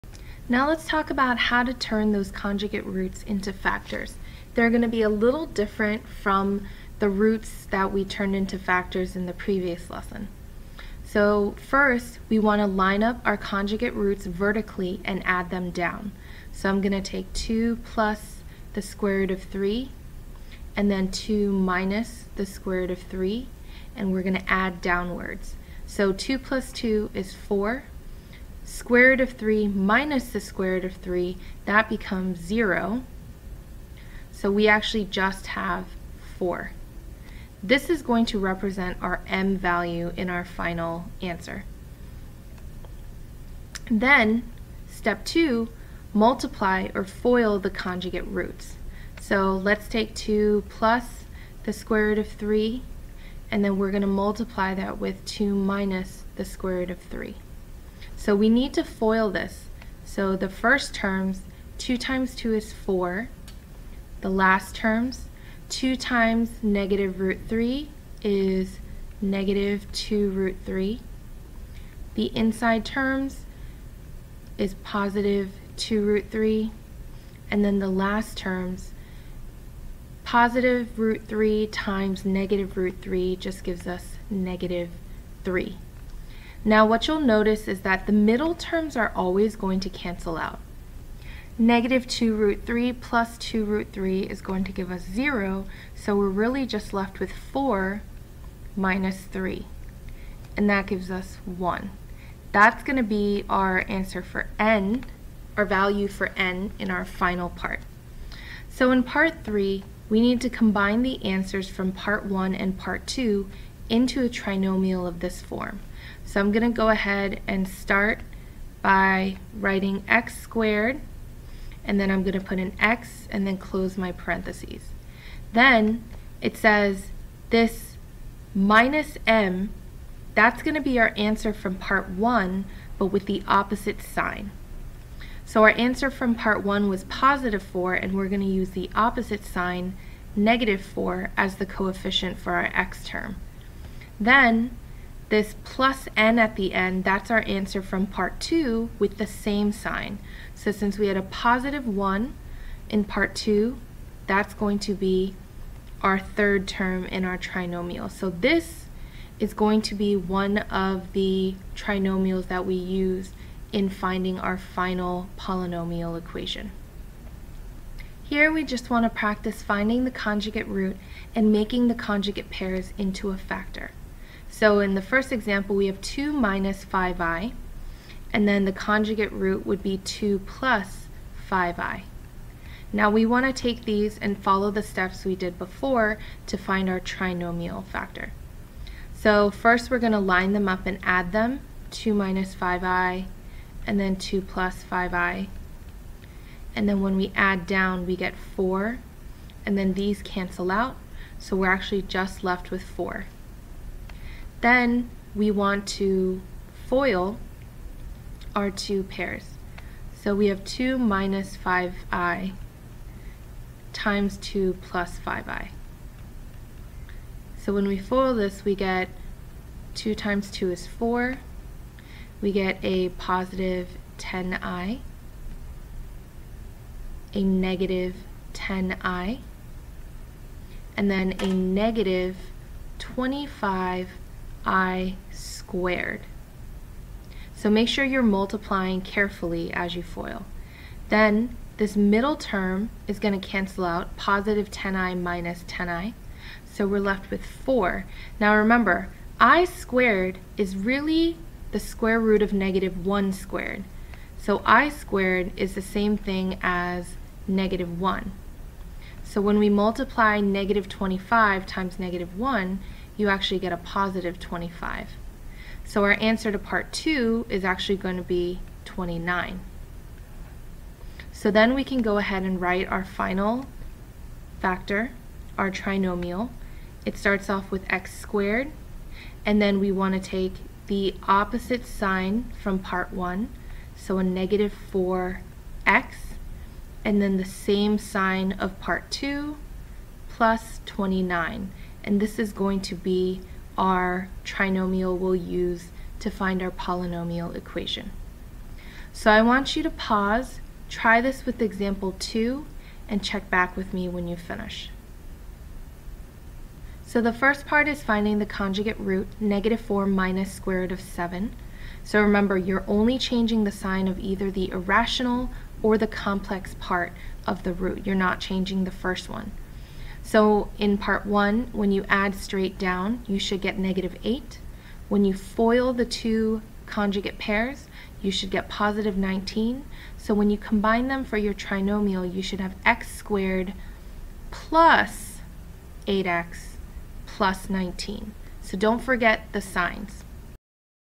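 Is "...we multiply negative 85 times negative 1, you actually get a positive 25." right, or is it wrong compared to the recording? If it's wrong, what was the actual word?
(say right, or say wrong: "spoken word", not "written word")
wrong: "25", not "85".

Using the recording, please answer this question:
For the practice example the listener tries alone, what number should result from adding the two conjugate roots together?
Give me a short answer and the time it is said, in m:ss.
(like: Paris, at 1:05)
-8, at 5:23.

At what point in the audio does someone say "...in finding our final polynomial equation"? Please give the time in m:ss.
2:43.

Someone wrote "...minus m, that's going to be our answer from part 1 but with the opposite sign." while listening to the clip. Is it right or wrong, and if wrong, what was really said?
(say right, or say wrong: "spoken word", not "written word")
right.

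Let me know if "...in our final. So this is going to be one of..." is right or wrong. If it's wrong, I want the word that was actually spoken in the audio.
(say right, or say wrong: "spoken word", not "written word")
wrong: "trinomial", not "final".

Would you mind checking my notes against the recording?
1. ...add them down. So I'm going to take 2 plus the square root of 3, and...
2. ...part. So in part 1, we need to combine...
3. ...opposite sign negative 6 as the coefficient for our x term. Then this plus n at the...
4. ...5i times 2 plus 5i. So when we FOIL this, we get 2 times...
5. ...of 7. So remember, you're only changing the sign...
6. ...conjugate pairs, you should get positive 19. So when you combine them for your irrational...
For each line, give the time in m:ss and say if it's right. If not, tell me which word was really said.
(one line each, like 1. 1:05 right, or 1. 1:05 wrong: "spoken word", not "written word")
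1. 0:15 right
2. 1:47 wrong: "3", not "1"
3. 2:18 wrong: "4", not "6"
4. 3:31 right
5. 5:10 right
6. 5:26 wrong: "trinomial", not "irrational".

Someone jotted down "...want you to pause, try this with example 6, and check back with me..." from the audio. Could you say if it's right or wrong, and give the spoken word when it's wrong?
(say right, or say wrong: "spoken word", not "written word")
wrong: "2", not "6".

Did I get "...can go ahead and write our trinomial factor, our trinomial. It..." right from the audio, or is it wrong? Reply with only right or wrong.
wrong.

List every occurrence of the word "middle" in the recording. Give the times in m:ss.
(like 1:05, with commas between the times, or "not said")
1:28, 4:01.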